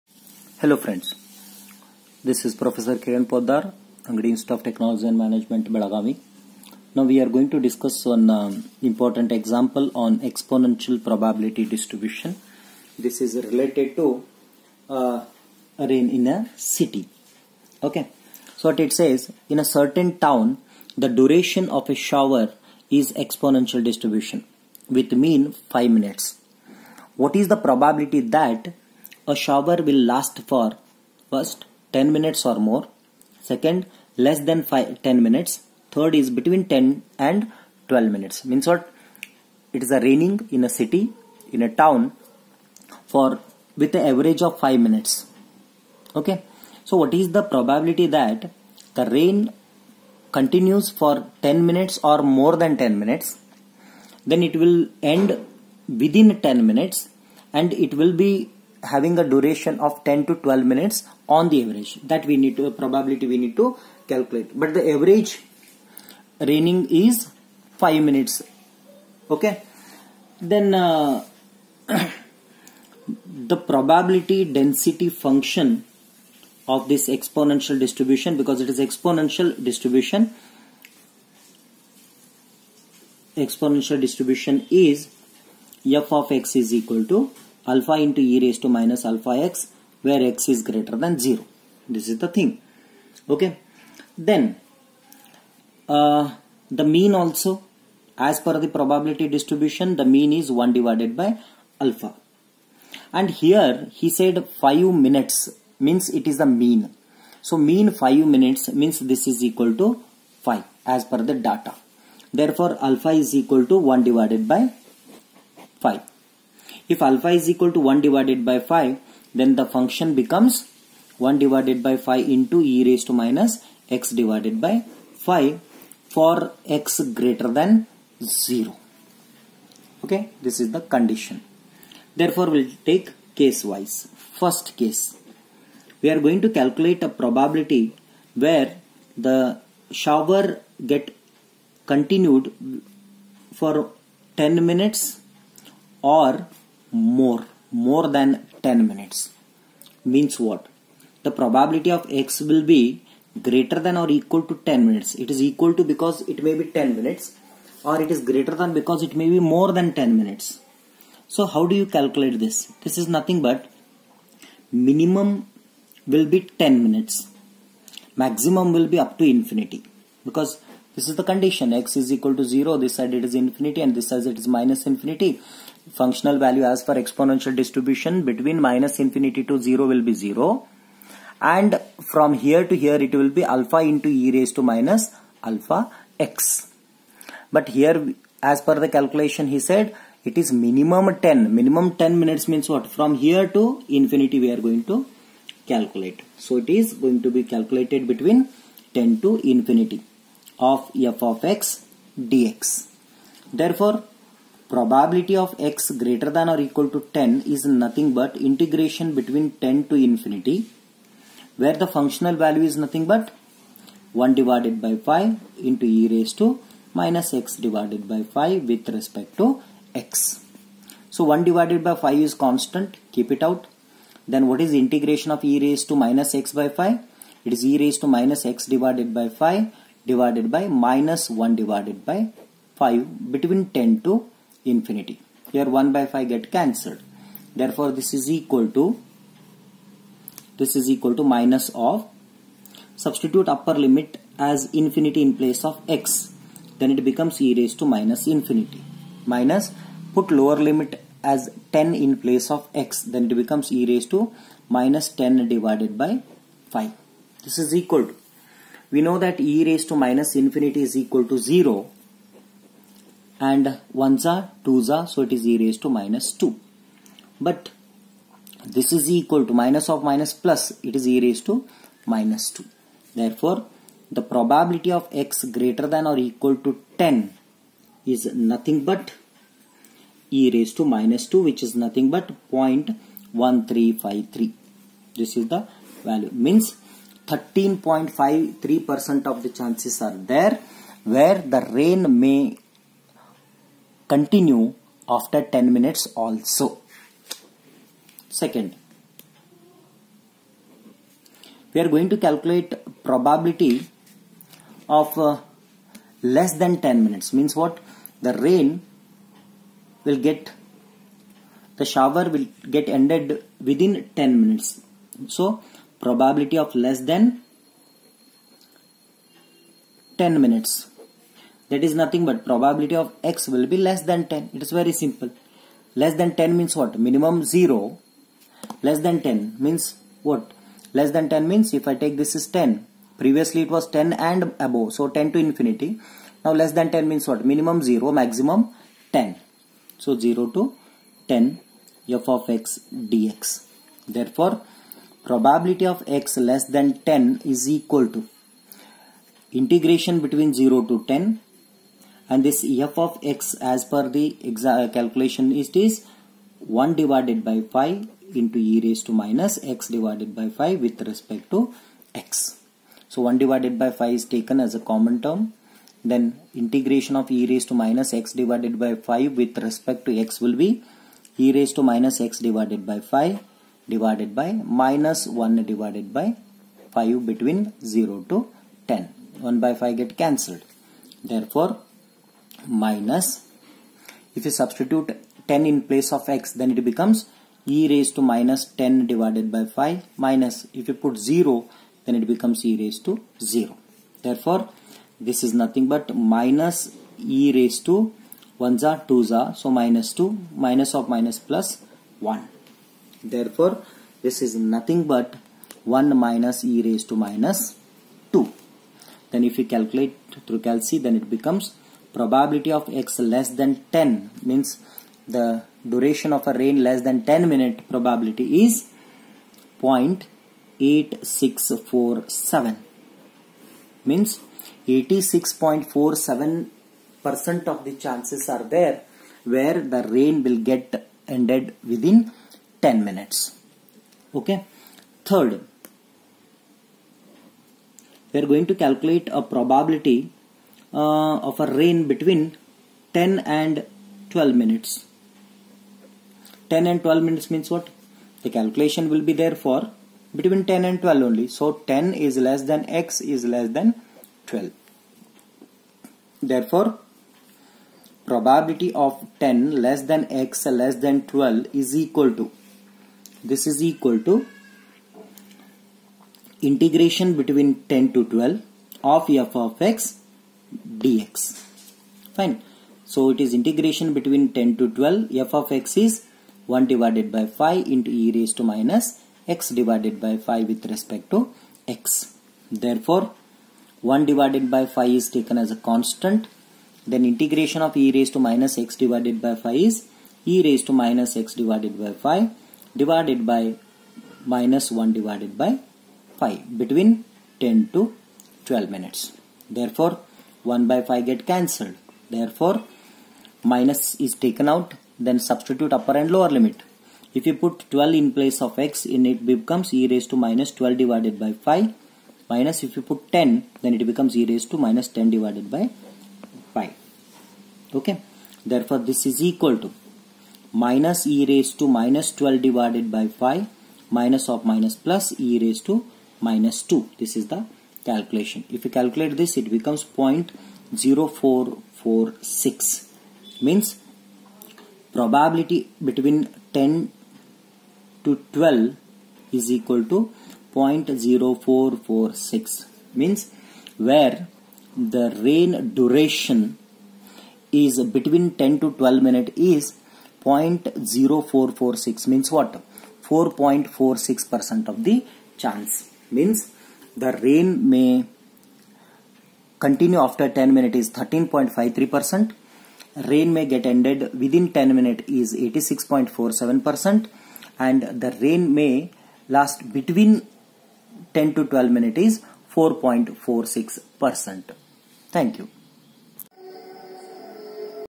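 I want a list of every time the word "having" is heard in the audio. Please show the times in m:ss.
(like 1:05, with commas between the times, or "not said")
0:58.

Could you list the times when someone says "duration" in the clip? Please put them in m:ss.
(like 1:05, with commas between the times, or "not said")
0:21, 0:59, 6:55, 9:05.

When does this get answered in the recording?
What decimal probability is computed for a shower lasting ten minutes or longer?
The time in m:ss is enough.
4:42.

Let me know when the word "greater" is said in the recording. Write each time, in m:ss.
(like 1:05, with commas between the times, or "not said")
1:30, 2:07, 2:33, 2:38, 3:26, 4:35.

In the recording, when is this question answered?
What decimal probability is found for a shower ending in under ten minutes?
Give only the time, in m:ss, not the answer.
6:59.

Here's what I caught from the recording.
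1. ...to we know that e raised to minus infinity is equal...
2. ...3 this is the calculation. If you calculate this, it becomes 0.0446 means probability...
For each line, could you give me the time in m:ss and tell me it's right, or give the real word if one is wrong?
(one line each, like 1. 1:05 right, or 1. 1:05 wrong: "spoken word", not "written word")
1. 4:18 right
2. 8:46 wrong: "2", not "3".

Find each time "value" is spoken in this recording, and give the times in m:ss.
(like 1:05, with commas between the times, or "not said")
2:56, 3:32, 4:46.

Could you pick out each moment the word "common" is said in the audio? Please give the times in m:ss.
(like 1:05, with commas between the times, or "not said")
6:04.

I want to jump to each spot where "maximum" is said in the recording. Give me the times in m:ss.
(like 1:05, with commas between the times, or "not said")
2:48, 5:38.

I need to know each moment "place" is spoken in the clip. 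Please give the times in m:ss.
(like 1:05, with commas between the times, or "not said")
4:05, 4:12, 6:25, 8:28.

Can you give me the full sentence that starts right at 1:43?
And here he said 5 minutes means it is the mean.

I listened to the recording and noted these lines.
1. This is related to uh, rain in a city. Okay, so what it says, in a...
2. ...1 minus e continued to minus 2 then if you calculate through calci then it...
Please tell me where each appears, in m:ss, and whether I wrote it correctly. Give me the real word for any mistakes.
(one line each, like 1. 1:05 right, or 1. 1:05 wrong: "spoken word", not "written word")
1. 0:12 right
2. 6:46 wrong: "raised", not "continued".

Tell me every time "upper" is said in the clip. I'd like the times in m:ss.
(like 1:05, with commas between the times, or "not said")
4:03, 8:25.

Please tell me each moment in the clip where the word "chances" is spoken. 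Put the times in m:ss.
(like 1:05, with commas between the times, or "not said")
4:49, 7:08, 9:15.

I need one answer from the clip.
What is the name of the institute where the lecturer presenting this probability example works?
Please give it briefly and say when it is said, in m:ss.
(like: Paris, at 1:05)
Angadi Institute of Technology and Management, at 0:04.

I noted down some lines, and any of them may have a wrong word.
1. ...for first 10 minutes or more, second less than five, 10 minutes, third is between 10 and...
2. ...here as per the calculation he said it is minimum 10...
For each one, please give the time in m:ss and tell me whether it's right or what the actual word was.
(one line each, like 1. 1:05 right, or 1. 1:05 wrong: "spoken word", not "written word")
1. 0:30 right
2. 3:07 right.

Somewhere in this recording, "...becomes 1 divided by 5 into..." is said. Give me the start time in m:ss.
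2:00.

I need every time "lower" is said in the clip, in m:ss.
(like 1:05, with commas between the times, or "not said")
4:10, 8:26.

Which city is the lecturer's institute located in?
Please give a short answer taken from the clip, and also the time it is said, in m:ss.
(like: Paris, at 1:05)
Belagavi, at 0:05.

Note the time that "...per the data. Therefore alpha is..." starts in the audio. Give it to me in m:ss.
1:51.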